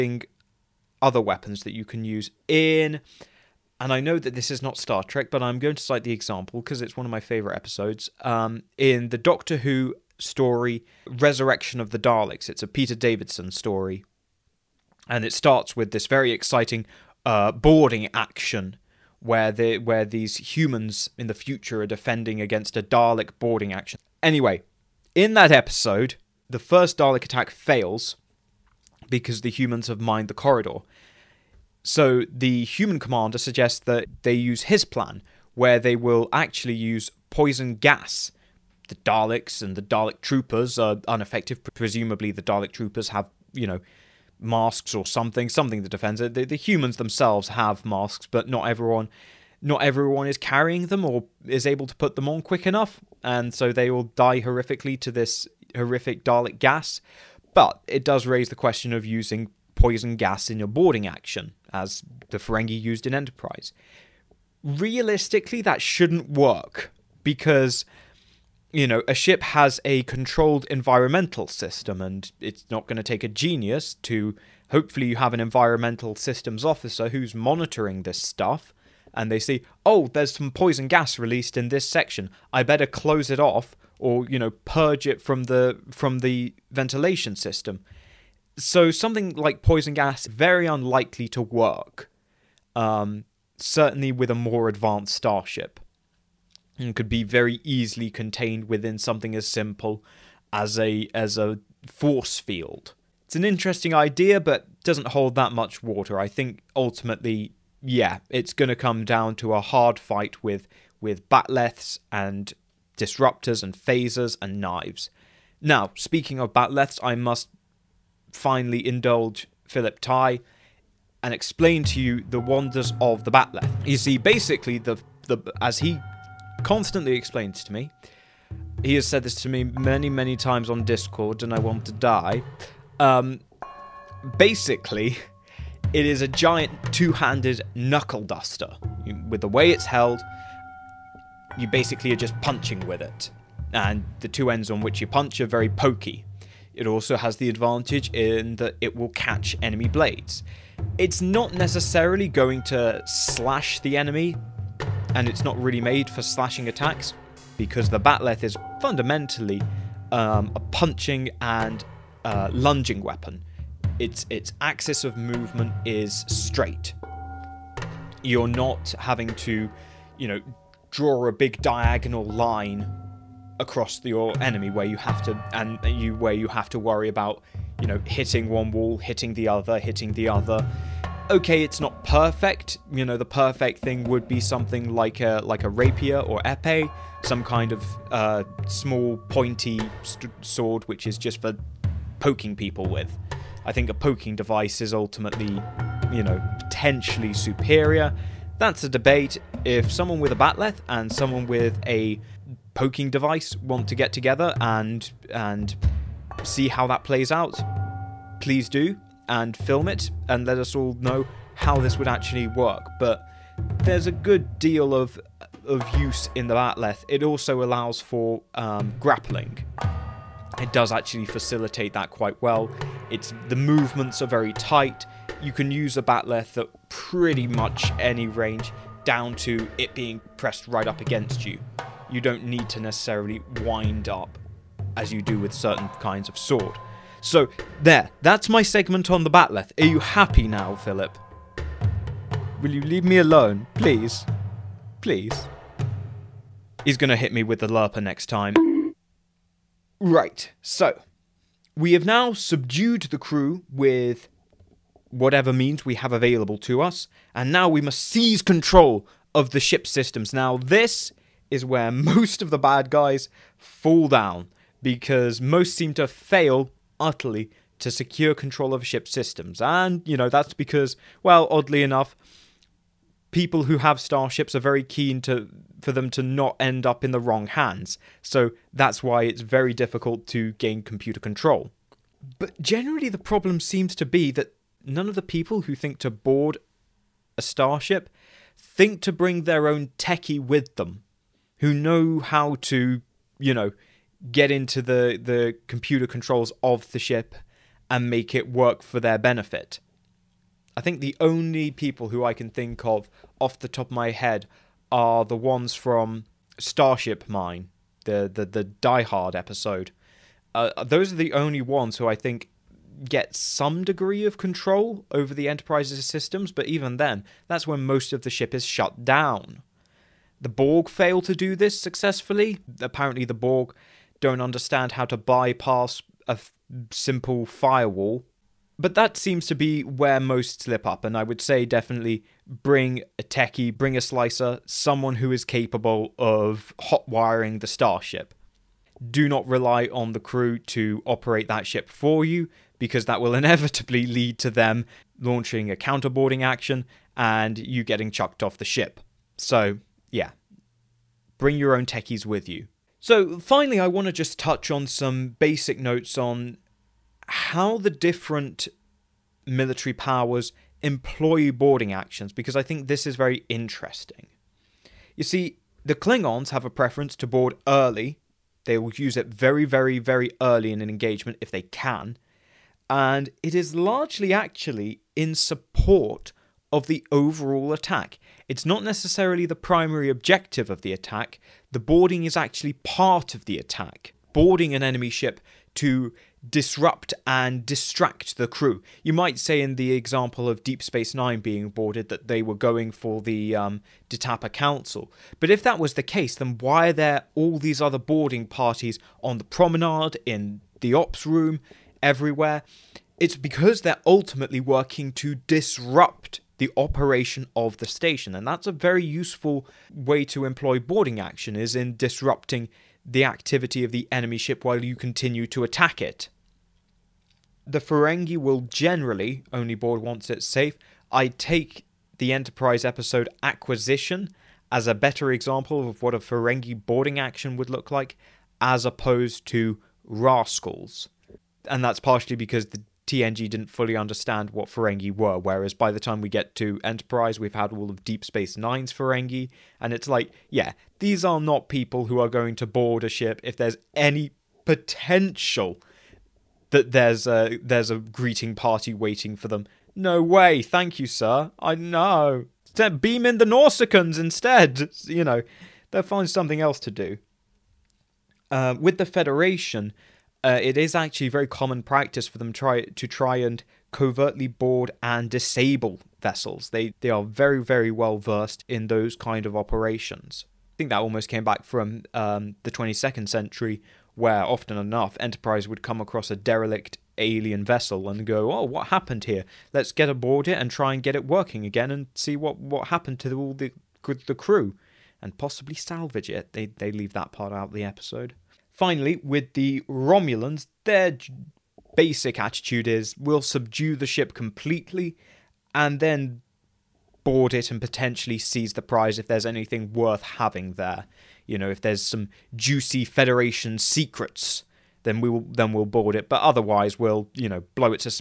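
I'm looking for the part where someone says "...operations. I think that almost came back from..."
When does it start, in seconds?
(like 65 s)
469 s.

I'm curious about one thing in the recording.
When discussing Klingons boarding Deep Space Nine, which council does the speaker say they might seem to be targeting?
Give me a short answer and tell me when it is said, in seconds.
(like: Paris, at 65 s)
Detapa Council, at 394 s.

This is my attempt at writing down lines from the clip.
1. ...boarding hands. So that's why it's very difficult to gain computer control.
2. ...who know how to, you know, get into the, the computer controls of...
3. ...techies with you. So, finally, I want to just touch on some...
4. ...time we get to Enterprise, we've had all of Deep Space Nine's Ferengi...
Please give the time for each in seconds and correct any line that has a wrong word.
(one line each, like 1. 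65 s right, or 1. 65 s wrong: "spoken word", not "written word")
1. 277 s wrong: "wrong", not "boarding"
2. 291 s right
3. 351 s right
4. 435 s right.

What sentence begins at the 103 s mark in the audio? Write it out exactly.
It's an interesting idea, but doesn't hold that much water.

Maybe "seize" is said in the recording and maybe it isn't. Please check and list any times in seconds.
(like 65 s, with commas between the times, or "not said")
258 s, 498 s.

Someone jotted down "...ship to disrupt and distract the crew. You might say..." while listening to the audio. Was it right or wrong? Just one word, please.
right.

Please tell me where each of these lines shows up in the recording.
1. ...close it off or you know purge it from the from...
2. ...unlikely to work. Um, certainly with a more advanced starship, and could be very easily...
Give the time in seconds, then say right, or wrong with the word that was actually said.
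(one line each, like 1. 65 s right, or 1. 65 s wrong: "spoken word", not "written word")
1. 82 s right
2. 90 s right.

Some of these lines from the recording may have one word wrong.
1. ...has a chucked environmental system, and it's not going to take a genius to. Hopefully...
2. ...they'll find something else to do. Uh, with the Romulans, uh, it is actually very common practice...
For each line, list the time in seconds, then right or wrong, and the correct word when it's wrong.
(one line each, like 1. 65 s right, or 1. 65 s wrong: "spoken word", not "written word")
1. 69 s wrong: "controlled", not "chucked"
2. 455 s wrong: "Federation", not "Romulans".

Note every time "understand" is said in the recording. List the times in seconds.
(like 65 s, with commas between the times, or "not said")
324 s, 433 s.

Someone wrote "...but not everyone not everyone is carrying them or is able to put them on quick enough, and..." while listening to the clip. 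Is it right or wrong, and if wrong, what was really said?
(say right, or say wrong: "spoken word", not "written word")
right.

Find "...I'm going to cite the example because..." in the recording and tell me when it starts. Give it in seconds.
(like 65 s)
5 s.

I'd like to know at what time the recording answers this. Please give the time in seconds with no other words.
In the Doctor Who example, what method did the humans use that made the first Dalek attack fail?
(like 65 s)
30 s.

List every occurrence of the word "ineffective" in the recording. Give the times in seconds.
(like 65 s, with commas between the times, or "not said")
41 s.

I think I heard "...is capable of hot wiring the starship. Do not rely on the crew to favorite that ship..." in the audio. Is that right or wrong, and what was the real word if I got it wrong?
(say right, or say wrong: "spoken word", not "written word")
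wrong: "operate", not "favorite".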